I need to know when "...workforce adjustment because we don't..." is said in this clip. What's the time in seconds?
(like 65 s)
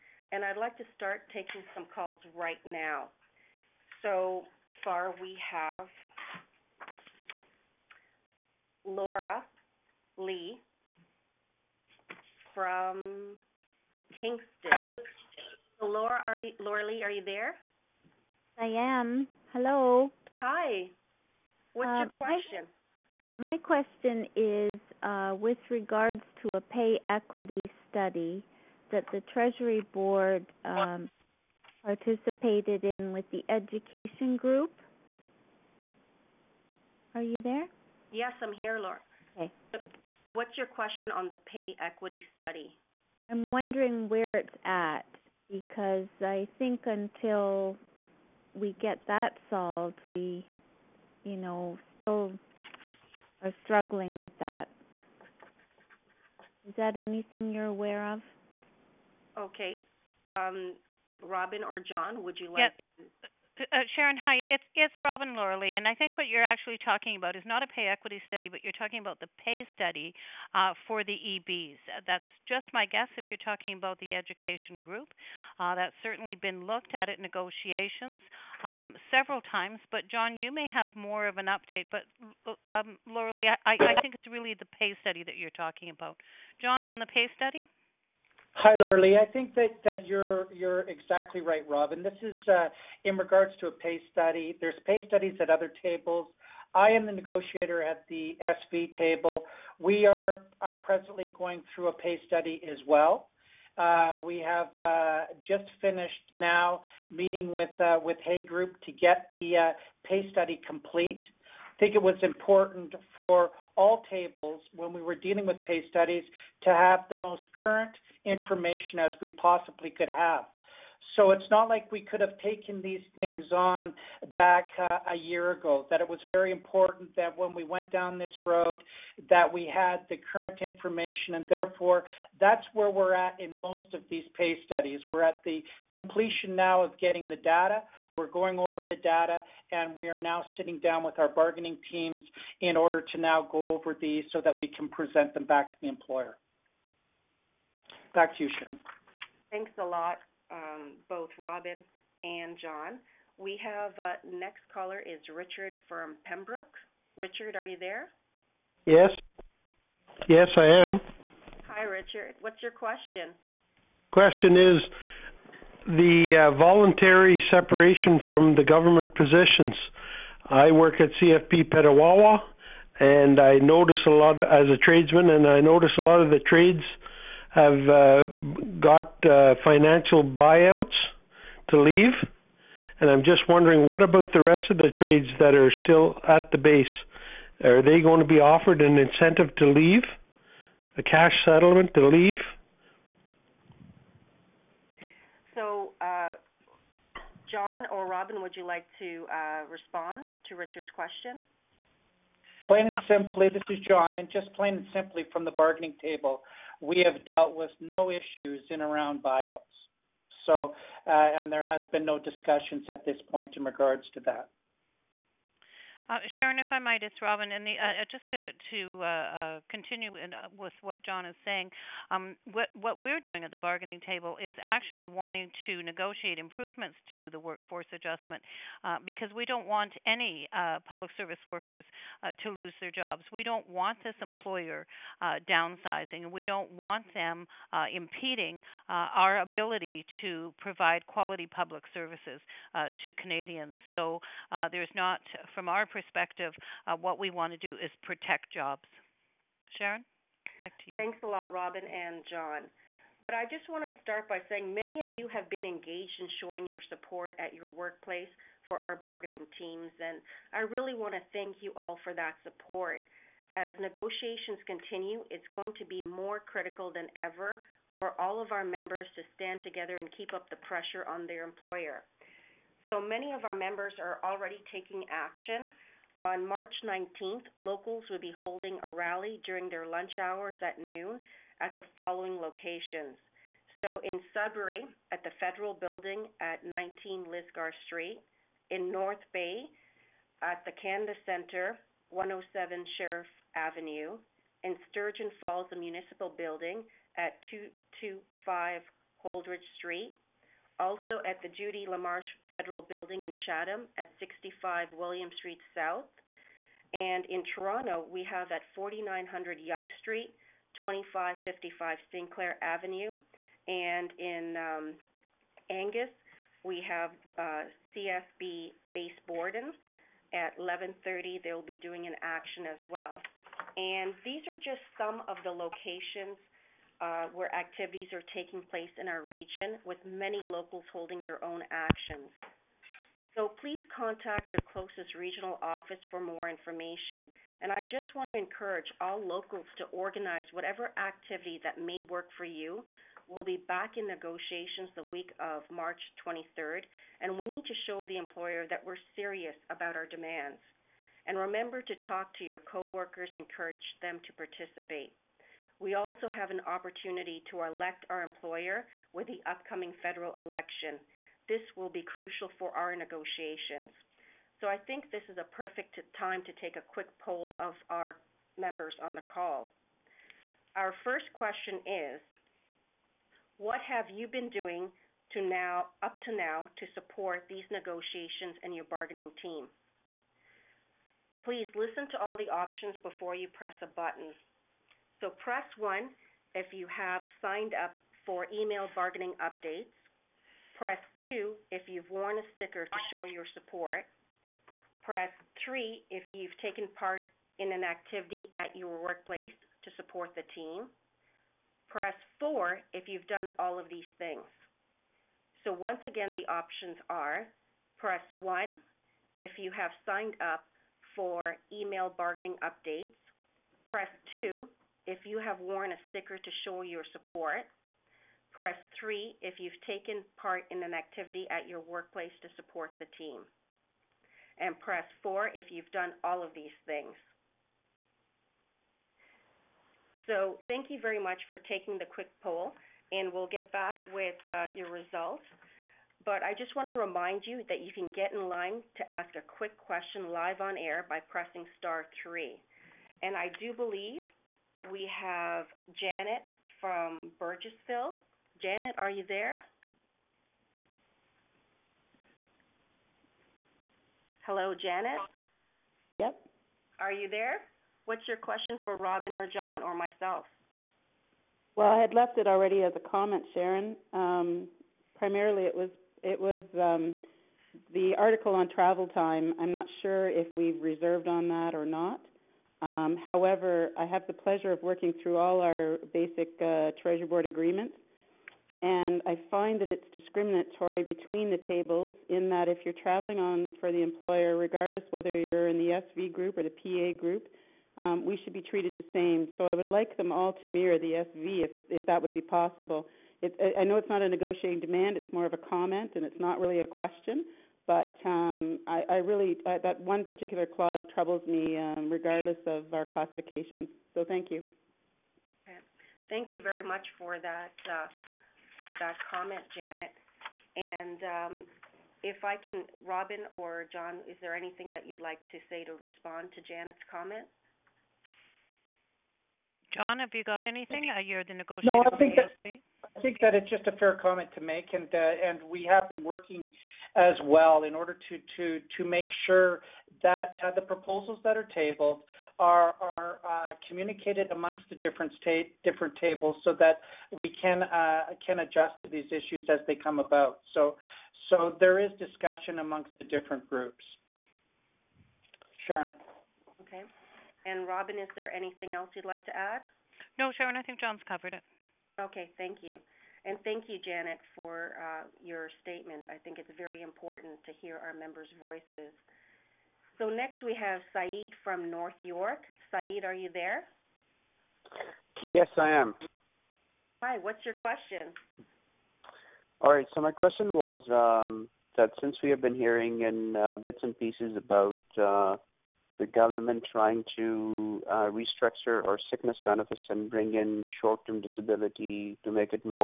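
227 s.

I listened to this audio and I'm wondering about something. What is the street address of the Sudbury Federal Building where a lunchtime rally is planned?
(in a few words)
19 Lisgar Street.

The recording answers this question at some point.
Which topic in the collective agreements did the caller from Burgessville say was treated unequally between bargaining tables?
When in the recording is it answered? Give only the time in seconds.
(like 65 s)
468 s.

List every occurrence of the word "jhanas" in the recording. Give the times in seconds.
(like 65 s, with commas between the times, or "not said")
not said.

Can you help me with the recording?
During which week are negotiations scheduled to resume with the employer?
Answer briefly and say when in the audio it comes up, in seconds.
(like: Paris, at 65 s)
week of March 23, at 344 s.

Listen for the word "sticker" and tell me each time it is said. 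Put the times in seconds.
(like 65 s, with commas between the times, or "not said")
392 s, 416 s.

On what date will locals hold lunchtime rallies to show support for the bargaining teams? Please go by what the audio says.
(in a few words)
March 19.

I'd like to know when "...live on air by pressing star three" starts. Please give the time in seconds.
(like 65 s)
440 s.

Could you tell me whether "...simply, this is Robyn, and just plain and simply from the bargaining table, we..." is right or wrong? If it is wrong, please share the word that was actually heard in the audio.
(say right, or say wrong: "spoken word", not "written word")
wrong: "John", not "Robyn".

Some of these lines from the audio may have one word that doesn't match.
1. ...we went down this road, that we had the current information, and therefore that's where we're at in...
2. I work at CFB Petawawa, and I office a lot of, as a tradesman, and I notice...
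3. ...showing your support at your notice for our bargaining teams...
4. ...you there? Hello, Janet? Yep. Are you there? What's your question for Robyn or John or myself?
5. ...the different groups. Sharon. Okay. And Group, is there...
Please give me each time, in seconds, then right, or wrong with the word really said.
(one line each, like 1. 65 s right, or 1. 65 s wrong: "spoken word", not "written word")
1. 127 s right
2. 170 s wrong: "notice", not "office"
3. 256 s wrong: "workplace", not "notice"
4. 449 s right
5. 543 s wrong: "Robyn", not "Group".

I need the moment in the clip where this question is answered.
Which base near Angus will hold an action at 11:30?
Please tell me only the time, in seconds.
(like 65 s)
317 s.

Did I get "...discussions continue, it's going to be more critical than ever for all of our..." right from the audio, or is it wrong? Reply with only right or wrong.
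wrong.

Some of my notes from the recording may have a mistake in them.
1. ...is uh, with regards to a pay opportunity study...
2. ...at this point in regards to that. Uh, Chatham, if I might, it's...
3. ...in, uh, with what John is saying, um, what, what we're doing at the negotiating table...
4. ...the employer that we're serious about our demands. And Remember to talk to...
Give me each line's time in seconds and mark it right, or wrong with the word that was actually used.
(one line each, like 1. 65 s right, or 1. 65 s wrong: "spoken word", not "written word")
1. 24 s wrong: "equity", not "opportunity"
2. 212 s wrong: "Sharon", not "Chatham"
3. 220 s wrong: "bargaining", not "negotiating"
4. 348 s right.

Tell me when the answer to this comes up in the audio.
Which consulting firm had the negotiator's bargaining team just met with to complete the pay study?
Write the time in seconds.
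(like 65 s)
107 s.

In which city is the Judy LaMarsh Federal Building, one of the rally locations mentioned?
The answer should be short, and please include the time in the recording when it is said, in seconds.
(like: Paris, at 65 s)
Chatham, at 303 s.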